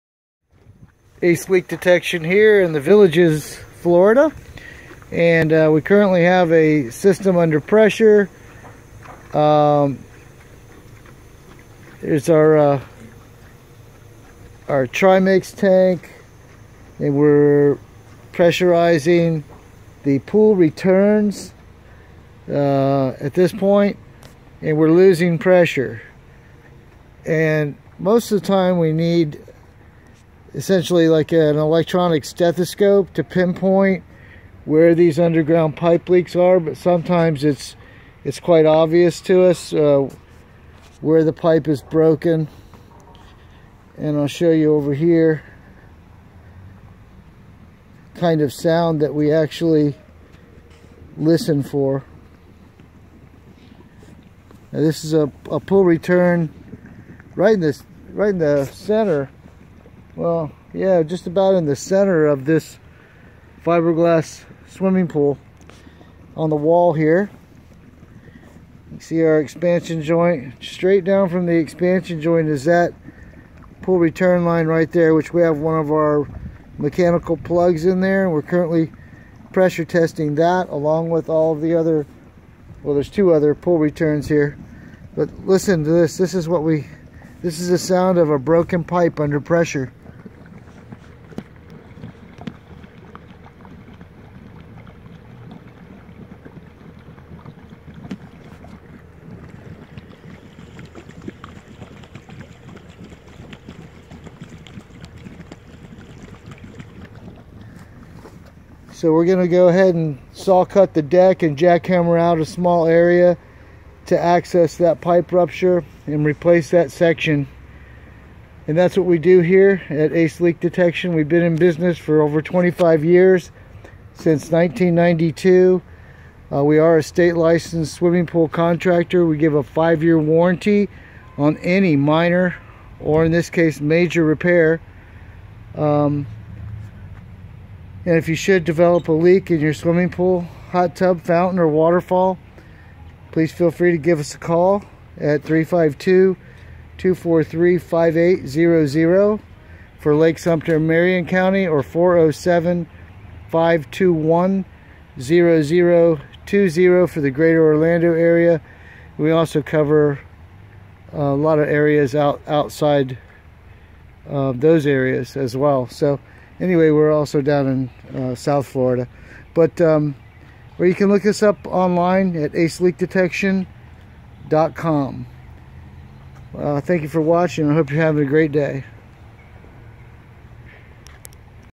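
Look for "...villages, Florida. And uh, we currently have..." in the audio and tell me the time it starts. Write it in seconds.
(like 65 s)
2 s.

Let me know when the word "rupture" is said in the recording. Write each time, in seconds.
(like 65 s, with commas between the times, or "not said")
115 s.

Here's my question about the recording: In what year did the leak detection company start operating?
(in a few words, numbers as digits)
1992.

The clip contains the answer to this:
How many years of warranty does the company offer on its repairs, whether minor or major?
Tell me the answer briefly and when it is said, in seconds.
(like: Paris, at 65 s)
5, at 129 s.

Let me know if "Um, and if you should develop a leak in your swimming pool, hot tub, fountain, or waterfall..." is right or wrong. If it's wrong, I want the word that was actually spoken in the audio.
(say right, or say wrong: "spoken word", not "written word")
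right.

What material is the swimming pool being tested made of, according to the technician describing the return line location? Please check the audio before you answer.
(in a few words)
Fiberglass.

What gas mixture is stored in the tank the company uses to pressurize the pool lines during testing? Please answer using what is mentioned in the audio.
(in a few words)
Trimix.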